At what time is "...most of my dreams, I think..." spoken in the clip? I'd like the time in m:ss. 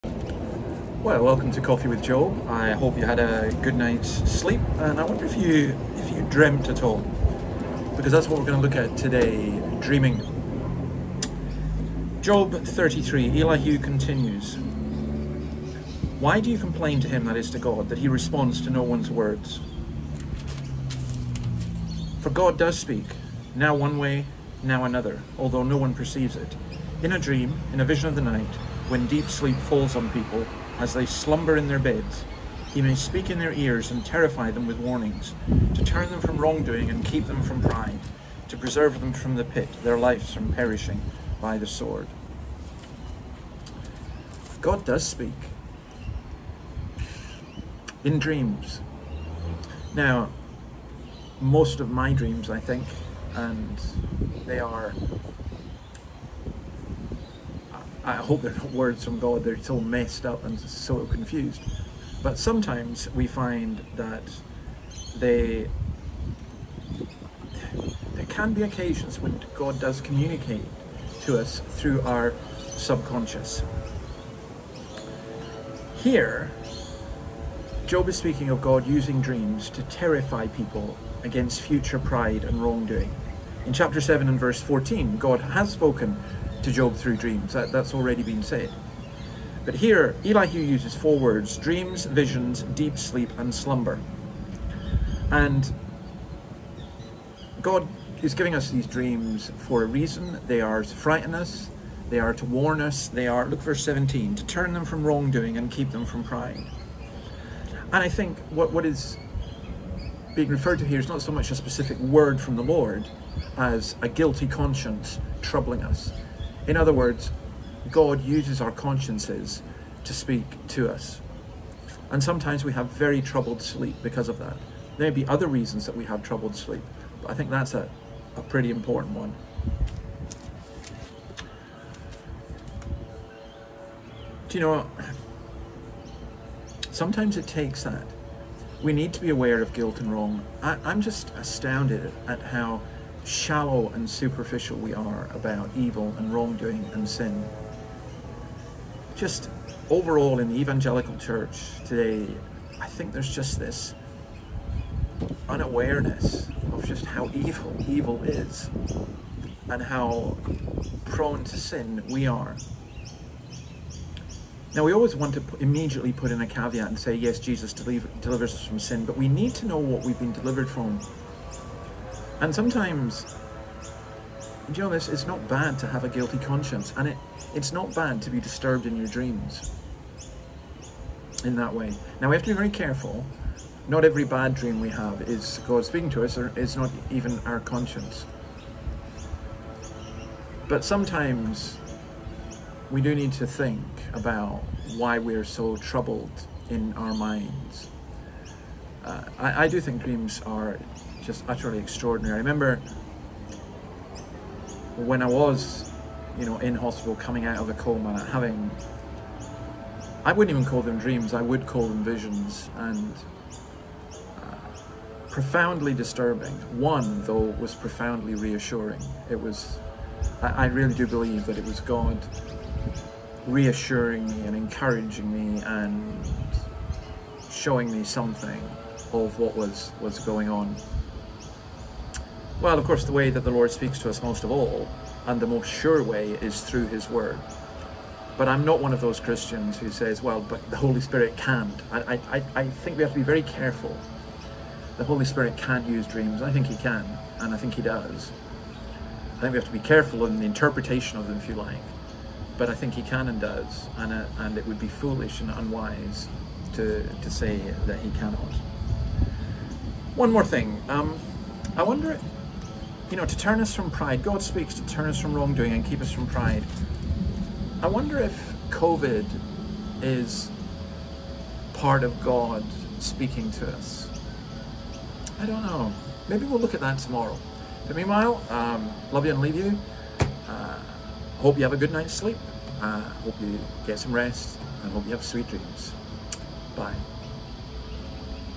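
0:51.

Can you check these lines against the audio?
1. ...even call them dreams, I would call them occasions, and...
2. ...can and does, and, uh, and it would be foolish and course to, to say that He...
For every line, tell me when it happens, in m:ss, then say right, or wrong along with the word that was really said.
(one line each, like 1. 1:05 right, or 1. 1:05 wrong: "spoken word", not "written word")
1. 3:30 wrong: "visions", not "occasions"
2. 4:13 wrong: "unwise", not "course".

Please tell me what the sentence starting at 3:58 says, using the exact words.
But I'm not one of those Christians who says, well, but the Holy Spirit can't.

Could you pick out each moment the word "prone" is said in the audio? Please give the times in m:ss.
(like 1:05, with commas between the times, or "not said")
2:41.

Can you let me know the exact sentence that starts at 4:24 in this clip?
God speaks to turn us from wrongdoing and keep us from pride.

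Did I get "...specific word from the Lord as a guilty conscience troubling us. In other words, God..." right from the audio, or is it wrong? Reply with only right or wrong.
right.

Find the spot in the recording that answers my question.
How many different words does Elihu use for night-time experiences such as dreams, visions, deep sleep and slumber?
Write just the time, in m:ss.
1:30.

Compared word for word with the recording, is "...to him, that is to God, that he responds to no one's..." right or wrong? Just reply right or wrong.
right.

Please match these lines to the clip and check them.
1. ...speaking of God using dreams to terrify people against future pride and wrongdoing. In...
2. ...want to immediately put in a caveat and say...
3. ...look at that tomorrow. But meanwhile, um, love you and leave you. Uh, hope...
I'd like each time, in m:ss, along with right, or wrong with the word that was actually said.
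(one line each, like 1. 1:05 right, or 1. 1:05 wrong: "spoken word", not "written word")
1. 1:18 right
2. 2:45 right
3. 4:36 right.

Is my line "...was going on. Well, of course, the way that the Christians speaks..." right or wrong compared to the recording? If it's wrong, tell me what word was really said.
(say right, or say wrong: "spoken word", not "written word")
wrong: "Lord", not "Christians".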